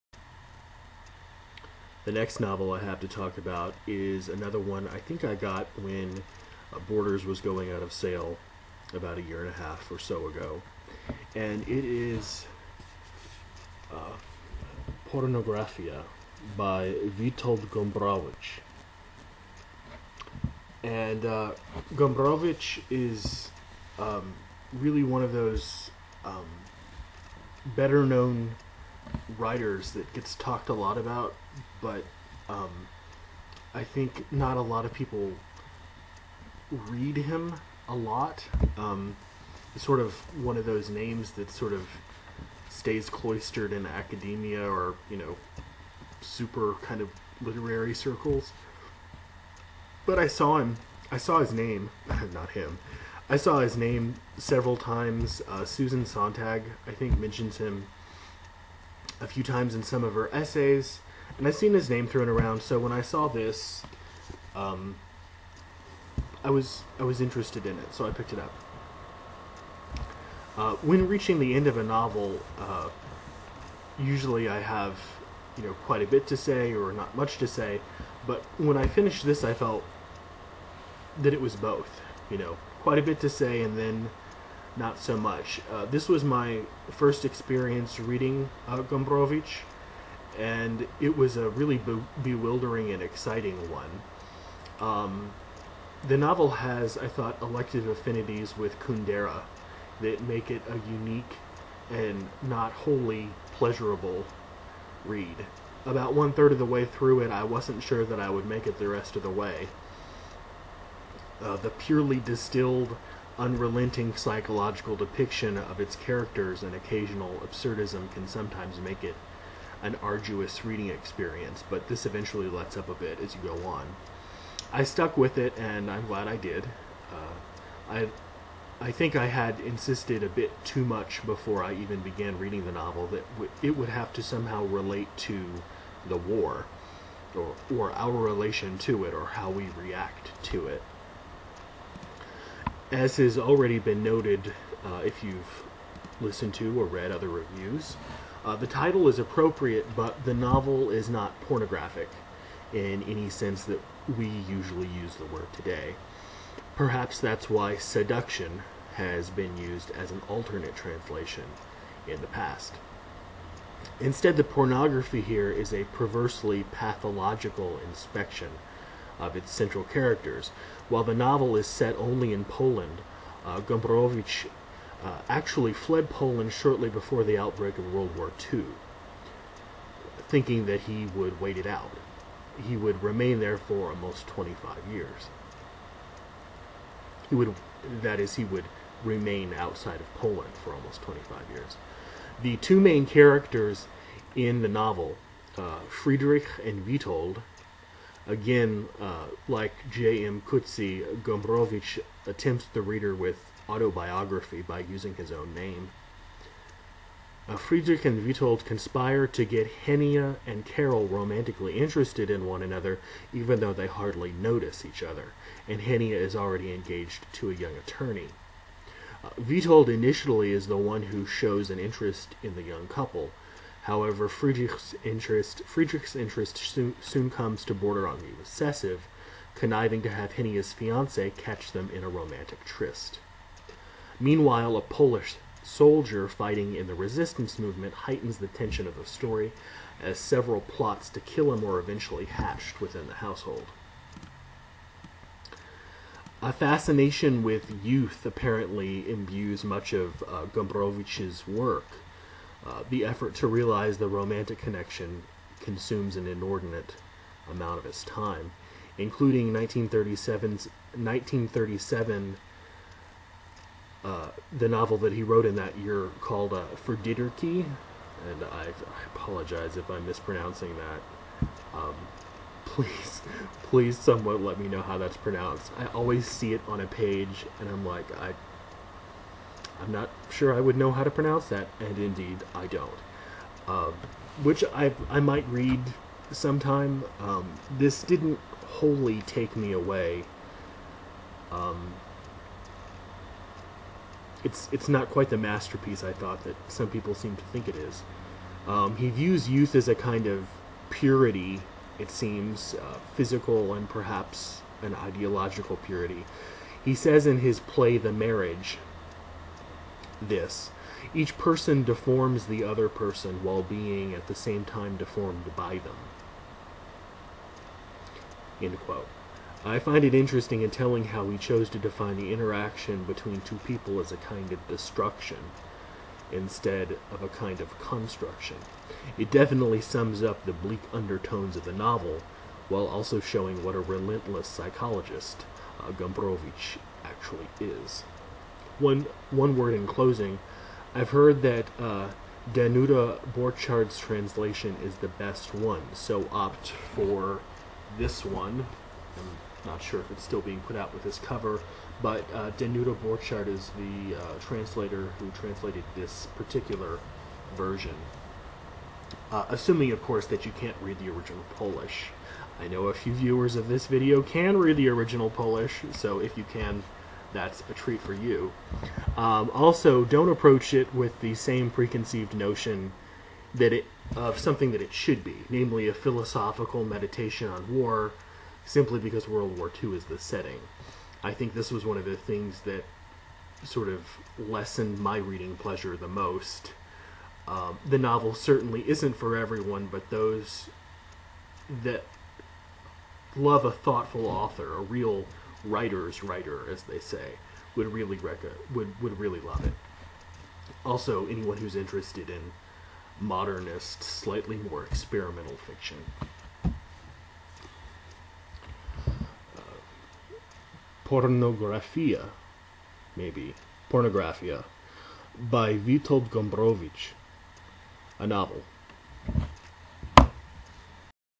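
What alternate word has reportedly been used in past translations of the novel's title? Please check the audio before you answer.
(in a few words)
seduction.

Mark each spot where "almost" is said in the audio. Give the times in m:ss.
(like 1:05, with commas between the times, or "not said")
3:03, 3:10.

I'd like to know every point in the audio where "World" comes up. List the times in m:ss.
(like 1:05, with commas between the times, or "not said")
2:57, 6:19.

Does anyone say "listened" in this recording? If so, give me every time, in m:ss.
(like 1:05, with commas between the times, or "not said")
2:26.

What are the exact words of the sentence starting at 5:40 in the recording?
I've heard that uh, Danuta Borchardt's translation is the best one, so opt for this one.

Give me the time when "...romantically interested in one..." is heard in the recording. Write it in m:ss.
3:31.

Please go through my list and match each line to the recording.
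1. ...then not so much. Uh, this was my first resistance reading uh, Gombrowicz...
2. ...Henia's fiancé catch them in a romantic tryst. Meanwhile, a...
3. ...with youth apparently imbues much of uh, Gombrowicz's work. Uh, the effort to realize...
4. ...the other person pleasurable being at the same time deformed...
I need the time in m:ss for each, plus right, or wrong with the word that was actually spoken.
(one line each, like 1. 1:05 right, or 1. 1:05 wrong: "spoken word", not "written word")
1. 1:23 wrong: "experience", not "resistance"
2. 3:50 right
3. 4:07 right
4. 5:12 wrong: "while", not "pleasurable".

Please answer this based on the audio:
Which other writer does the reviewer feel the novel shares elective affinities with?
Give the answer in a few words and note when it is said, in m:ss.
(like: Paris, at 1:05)
Kundera, at 1:38.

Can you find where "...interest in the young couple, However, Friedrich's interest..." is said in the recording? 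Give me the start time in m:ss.
3:41.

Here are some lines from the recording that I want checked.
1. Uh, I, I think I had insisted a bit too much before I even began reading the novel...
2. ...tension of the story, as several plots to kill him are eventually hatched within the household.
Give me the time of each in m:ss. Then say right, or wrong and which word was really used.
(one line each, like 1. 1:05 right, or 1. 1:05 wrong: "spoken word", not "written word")
1. 2:07 right
2. 3:58 right.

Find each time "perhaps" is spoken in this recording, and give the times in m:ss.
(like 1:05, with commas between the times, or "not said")
2:36, 5:03.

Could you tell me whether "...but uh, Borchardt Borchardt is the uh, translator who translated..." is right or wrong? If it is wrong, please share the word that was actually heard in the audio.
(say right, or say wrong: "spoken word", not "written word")
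wrong: "Danuta", not "Borchardt".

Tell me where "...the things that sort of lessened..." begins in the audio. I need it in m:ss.
6:22.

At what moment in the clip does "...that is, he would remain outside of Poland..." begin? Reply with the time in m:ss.
3:08.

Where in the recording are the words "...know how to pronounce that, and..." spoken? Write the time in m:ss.
4:40.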